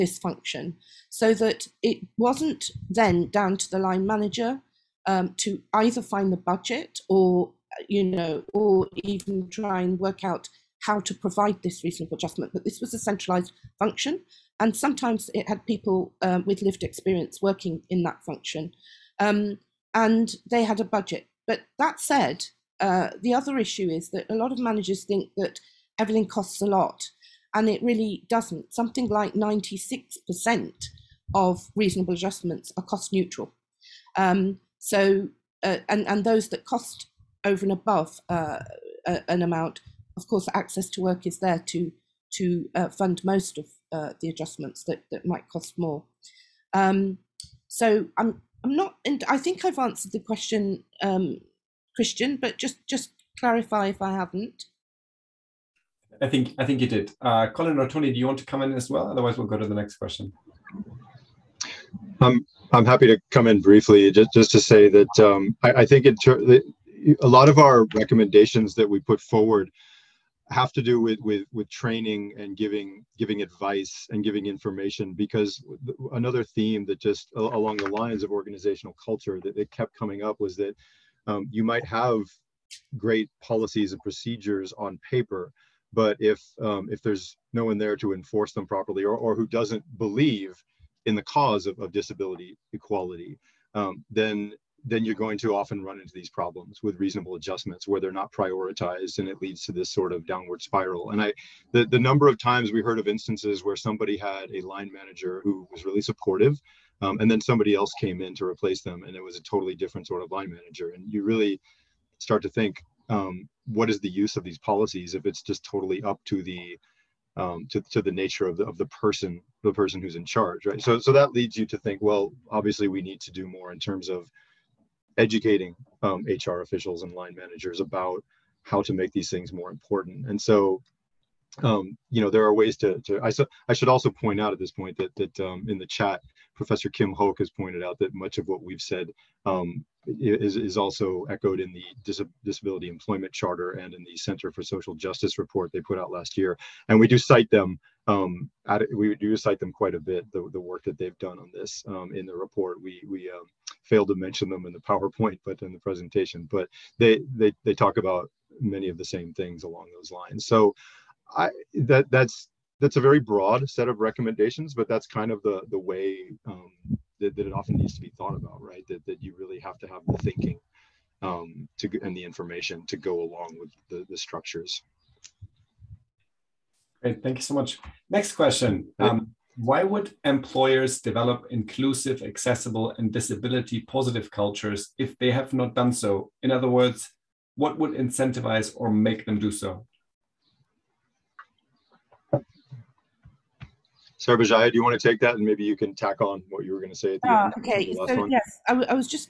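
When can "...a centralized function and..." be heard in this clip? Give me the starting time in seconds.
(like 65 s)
12 s.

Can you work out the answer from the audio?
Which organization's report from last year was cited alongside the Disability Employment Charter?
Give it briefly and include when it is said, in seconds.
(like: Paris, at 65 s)
Center for Social Justice, at 144 s.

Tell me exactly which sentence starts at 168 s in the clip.
That, that you really have to have the thinking um, to and the information to go along with the, the structures.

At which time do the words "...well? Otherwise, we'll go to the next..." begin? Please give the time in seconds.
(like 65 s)
58 s.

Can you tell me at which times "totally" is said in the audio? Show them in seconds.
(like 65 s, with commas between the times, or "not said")
109 s, 115 s.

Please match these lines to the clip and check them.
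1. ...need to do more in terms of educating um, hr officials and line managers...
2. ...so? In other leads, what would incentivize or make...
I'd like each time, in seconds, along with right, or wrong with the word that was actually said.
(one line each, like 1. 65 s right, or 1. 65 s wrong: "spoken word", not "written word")
1. 123 s right
2. 185 s wrong: "words", not "leads".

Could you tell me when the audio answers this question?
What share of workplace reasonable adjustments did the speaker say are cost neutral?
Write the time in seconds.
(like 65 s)
29 s.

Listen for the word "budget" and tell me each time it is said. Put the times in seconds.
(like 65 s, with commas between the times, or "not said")
6 s, 20 s.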